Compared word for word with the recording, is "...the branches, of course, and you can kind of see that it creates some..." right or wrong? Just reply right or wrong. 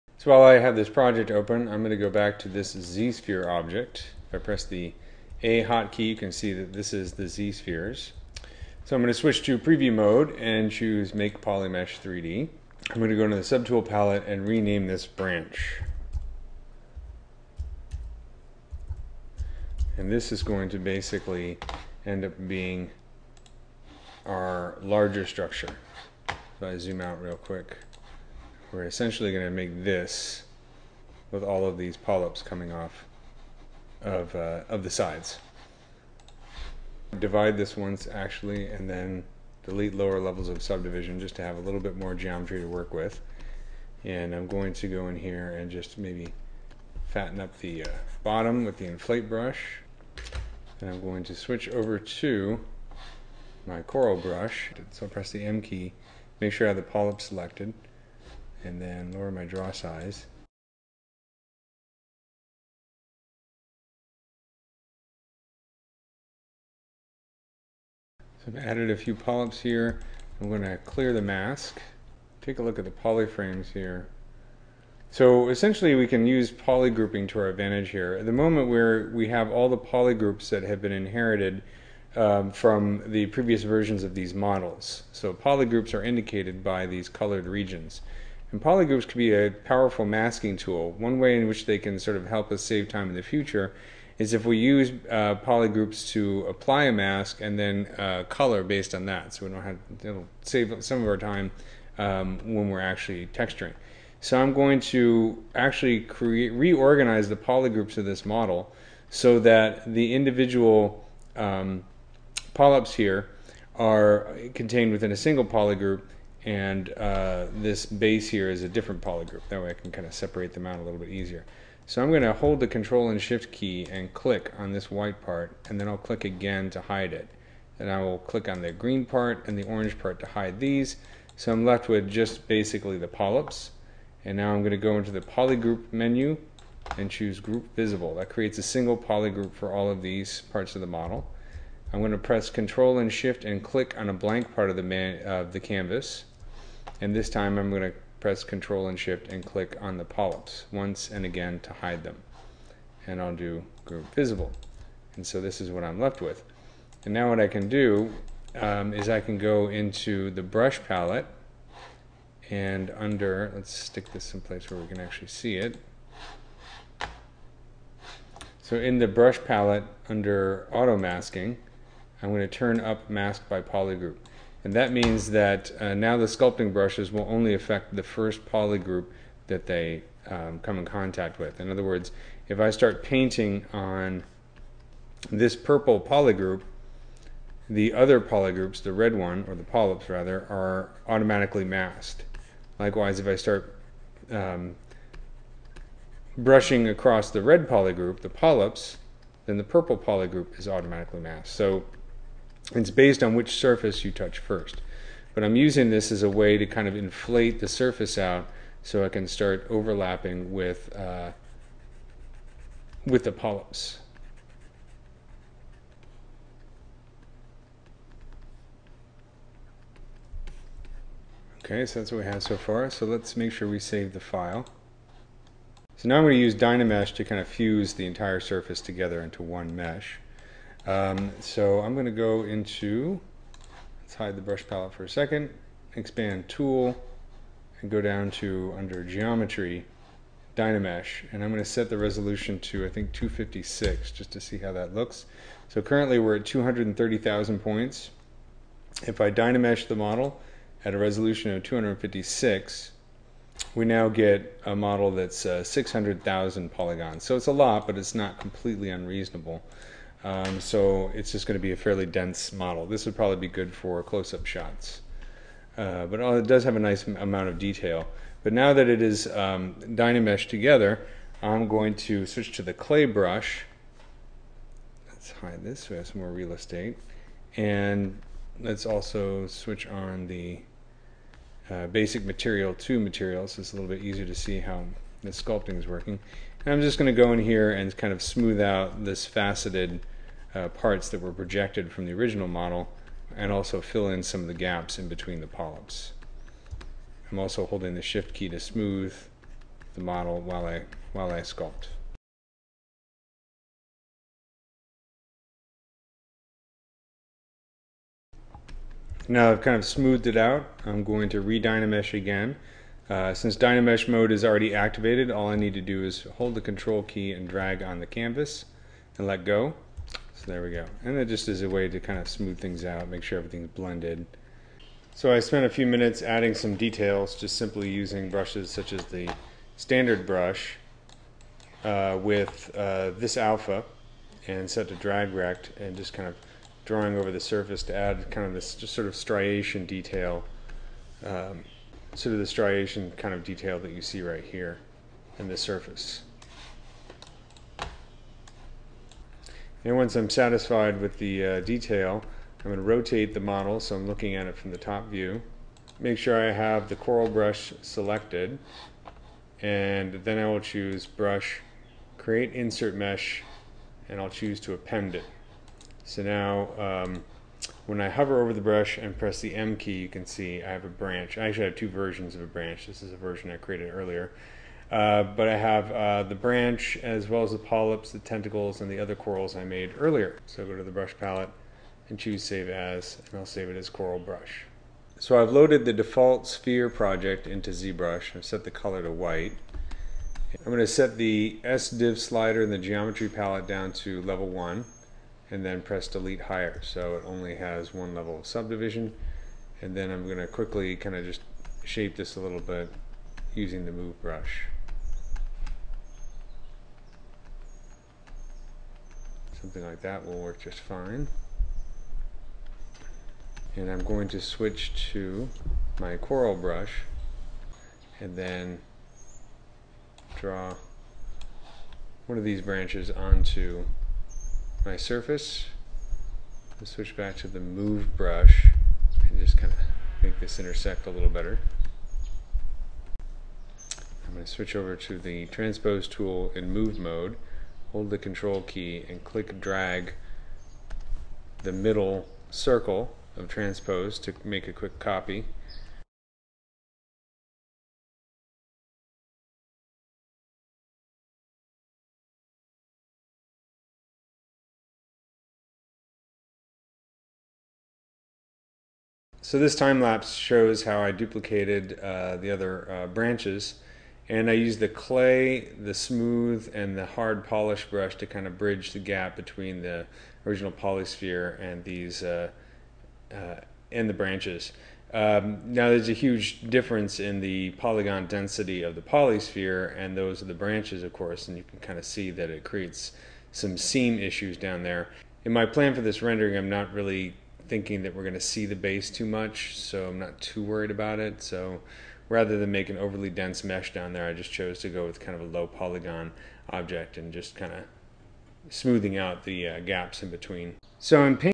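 right.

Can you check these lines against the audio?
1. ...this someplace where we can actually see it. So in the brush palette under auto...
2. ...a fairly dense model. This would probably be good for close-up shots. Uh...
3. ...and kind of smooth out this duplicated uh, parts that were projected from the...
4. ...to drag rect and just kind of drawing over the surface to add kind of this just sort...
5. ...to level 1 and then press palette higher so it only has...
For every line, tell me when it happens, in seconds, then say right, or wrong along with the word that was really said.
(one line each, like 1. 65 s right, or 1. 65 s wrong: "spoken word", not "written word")
1. 164 s right
2. 261 s right
3. 287 s wrong: "faceted", not "duplicated"
4. 334 s right
5. 393 s wrong: "delete", not "palette".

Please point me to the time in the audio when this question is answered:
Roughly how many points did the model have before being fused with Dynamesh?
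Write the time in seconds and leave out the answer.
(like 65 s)
246 s.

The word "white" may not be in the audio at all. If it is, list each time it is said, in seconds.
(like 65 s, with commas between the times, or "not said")
124 s, 389 s.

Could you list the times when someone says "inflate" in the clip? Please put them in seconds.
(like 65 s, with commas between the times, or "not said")
48 s, 206 s.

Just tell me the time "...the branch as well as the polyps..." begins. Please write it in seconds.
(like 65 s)
376 s.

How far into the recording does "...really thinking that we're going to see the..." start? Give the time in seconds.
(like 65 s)
486 s.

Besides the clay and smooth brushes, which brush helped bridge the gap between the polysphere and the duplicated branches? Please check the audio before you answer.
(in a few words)
Hard polish.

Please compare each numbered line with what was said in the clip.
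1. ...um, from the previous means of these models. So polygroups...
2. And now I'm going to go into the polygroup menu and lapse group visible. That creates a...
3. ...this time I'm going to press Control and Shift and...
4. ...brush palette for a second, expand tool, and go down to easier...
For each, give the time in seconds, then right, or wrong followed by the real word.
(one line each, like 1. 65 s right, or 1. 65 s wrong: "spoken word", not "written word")
1. 82 s wrong: "versions", not "means"
2. 134 s wrong: "choose", not "lapse"
3. 147 s right
4. 234 s wrong: "under", not "easier".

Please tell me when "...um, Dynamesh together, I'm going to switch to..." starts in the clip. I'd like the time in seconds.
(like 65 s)
269 s.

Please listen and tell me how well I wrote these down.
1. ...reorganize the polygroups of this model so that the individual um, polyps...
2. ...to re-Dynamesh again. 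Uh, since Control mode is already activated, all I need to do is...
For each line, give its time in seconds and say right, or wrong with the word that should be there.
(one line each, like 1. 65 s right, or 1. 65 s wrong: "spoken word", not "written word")
1. 106 s right
2. 311 s wrong: "Dynamesh", not "Control".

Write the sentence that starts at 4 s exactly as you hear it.
If I press the A hotkey, you can see that this is the z-spheres.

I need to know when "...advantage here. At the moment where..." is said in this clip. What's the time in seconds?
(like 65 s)
77 s.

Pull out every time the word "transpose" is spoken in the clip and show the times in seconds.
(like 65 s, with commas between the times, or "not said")
435 s, 443 s.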